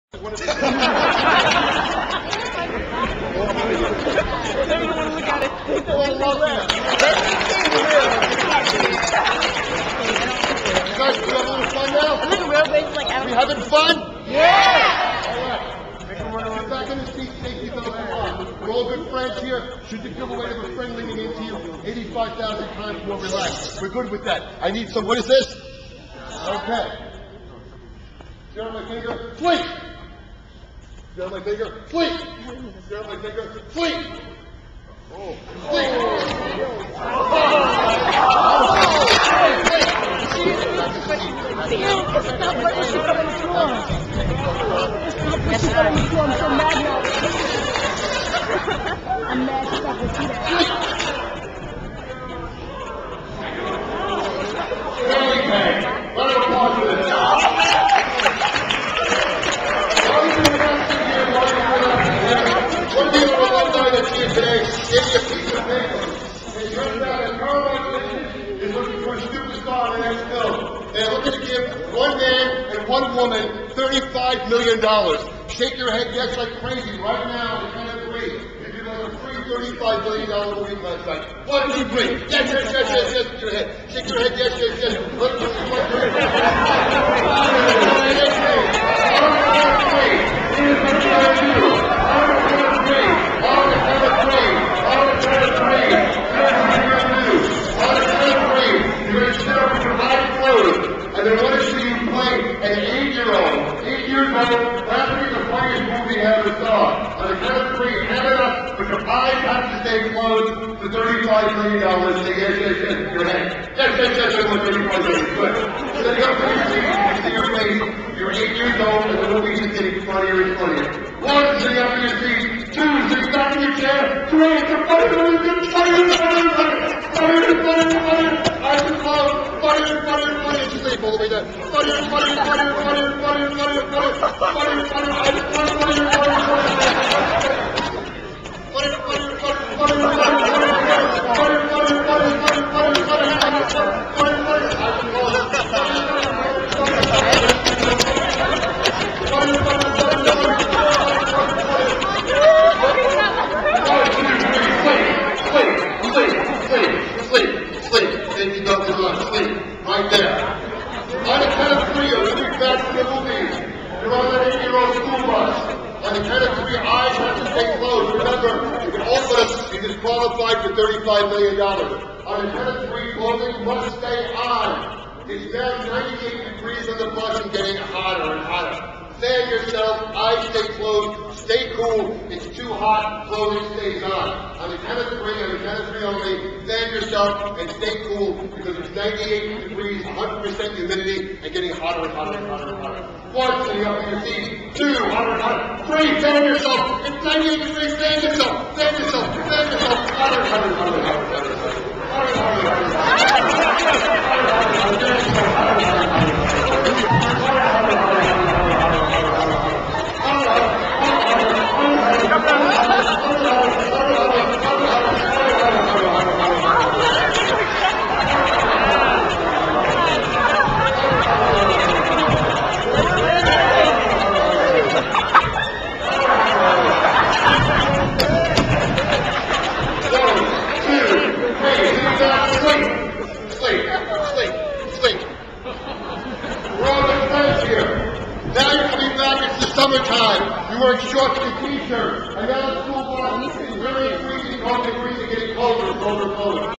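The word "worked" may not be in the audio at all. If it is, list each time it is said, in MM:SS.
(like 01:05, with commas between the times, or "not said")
not said.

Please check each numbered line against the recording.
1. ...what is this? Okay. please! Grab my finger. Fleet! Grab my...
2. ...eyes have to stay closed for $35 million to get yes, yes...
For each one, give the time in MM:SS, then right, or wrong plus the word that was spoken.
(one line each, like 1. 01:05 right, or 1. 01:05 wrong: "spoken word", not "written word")
1. 00:25 right
2. 01:49 right.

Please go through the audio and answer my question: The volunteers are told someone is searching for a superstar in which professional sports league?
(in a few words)
NFL.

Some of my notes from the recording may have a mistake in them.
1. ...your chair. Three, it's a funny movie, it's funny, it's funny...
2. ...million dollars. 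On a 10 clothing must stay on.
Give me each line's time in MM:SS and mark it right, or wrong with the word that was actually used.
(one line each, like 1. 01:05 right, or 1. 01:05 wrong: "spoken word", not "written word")
1. 02:03 right
2. 02:51 right.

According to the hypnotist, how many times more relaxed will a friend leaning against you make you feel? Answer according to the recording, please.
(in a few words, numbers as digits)
85,000.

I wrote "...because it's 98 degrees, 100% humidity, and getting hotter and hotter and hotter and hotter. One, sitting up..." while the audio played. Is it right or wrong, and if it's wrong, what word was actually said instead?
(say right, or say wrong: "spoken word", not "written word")
right.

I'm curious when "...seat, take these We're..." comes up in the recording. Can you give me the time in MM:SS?
00:17.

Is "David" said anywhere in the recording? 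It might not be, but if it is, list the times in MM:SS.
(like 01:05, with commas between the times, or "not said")
not said.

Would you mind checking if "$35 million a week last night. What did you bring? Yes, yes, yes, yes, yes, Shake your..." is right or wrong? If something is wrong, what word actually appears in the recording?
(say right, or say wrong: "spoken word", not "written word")
right.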